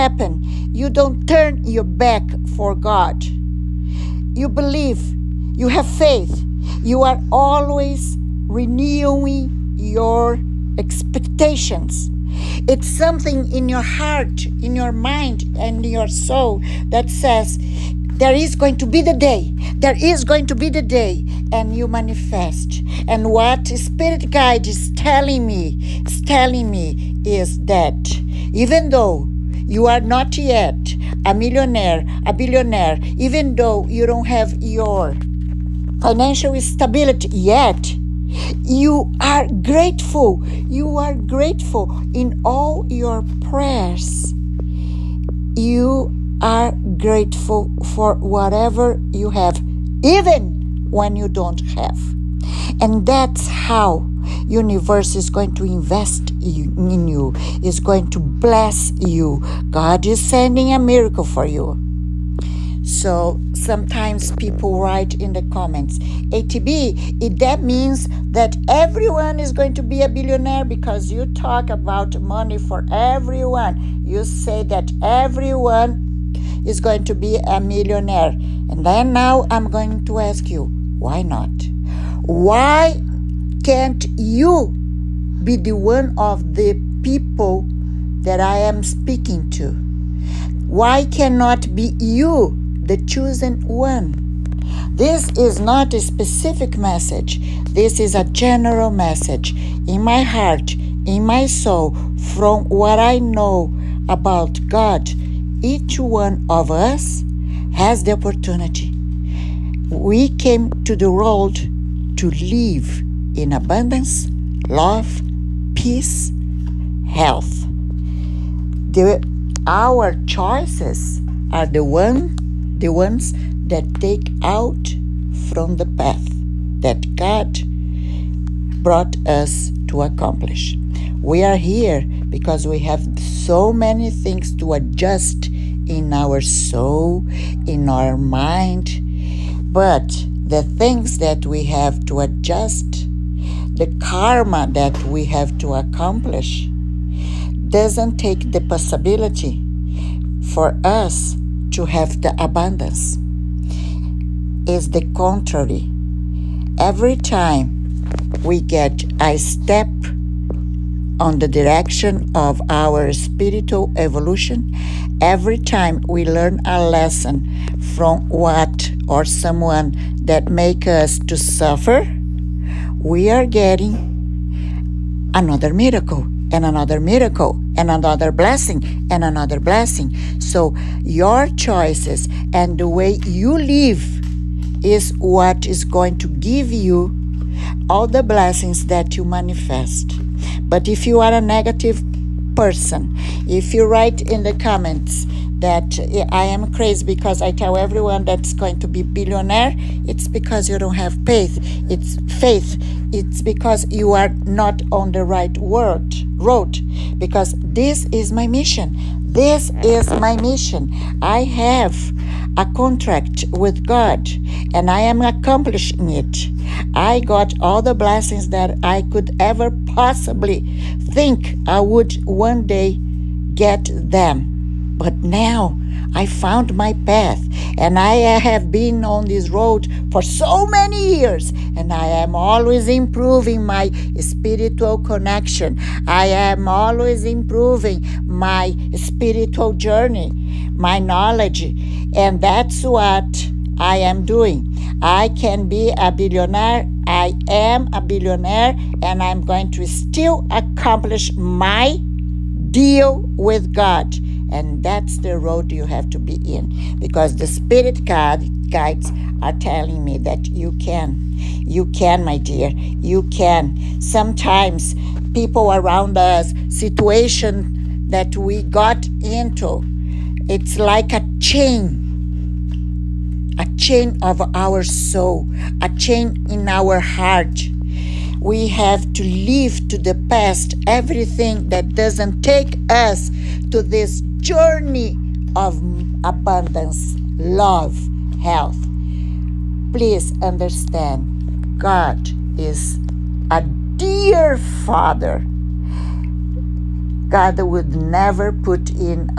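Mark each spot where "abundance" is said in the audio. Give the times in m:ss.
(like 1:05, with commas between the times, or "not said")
1:53, 2:32, 4:46.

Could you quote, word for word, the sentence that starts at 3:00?
So your choices and the way you live is what is going to give you all the blessings that you manifest.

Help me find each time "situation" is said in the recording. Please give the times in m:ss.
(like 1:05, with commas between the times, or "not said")
4:26.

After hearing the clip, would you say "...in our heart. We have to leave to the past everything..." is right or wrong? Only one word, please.
right.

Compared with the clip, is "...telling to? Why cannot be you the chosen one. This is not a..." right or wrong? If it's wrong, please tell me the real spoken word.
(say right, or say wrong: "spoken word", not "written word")
wrong: "speaking", not "telling".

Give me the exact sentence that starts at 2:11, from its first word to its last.
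We are here because we have so many things to adjust in our soul, in our mind.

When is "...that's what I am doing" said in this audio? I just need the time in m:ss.
4:02.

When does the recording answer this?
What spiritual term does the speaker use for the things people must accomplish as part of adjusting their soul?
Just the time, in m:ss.
2:23.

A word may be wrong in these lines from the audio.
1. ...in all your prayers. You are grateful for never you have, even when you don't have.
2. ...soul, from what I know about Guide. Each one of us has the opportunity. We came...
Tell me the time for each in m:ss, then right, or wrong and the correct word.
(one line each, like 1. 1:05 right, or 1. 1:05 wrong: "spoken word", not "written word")
1. 0:42 wrong: "whatever", not "never"
2. 1:41 wrong: "God", not "Guide".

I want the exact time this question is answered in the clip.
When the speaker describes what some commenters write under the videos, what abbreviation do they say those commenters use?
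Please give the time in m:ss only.
1:06.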